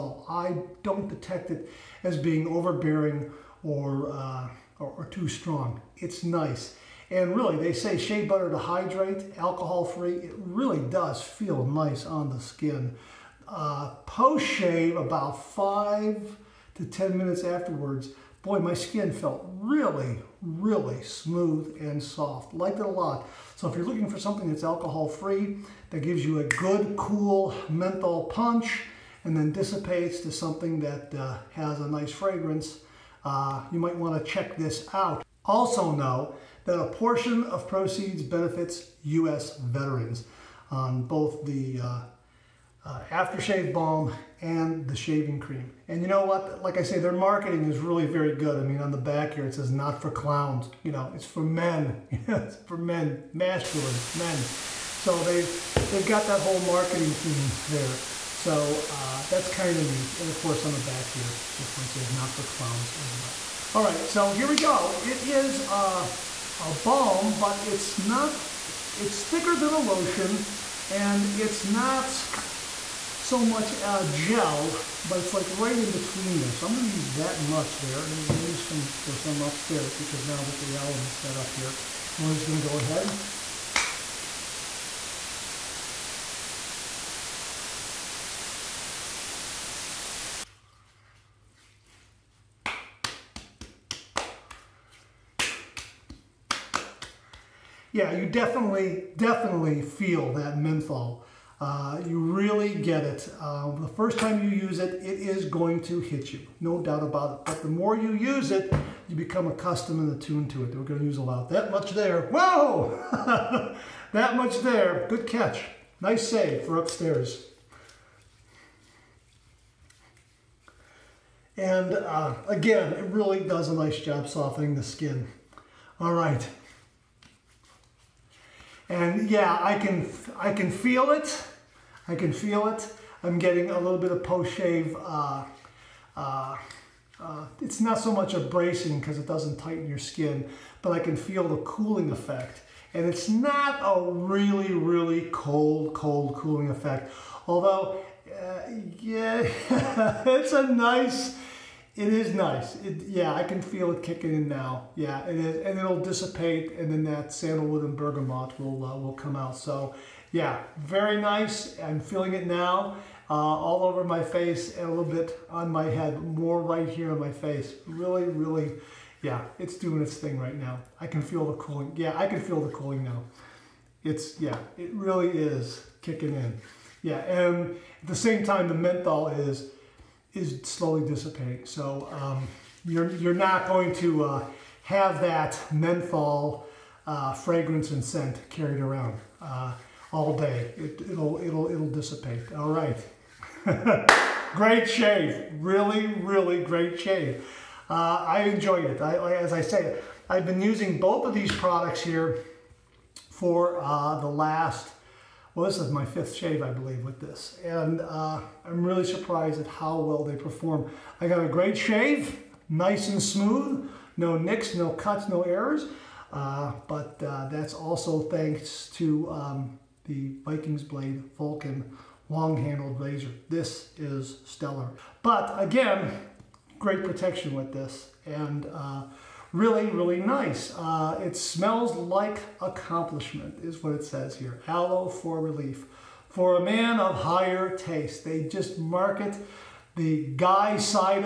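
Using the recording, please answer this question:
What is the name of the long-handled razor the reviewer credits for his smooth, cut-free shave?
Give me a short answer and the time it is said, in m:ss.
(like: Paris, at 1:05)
Vikings Blade Vulcan, at 3:40.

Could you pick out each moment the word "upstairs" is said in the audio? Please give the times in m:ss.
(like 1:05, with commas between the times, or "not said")
1:19, 1:56.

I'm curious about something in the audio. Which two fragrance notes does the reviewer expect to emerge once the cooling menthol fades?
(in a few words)
sandalwood and bergamot.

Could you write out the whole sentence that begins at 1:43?
Uh, the first time you use it, it is going to hit you, no doubt about it.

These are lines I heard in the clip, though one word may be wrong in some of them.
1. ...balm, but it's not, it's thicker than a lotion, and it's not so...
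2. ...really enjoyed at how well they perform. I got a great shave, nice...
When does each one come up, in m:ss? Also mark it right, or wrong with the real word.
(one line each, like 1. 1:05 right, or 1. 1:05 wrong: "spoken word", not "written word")
1. 1:06 right
2. 3:28 wrong: "surprised", not "enjoyed".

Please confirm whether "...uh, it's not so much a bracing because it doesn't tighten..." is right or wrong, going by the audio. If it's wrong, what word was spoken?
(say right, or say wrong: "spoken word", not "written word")
right.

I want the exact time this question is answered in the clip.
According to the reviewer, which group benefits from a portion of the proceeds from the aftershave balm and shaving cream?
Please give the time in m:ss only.
0:39.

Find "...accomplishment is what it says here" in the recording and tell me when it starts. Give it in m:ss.
3:52.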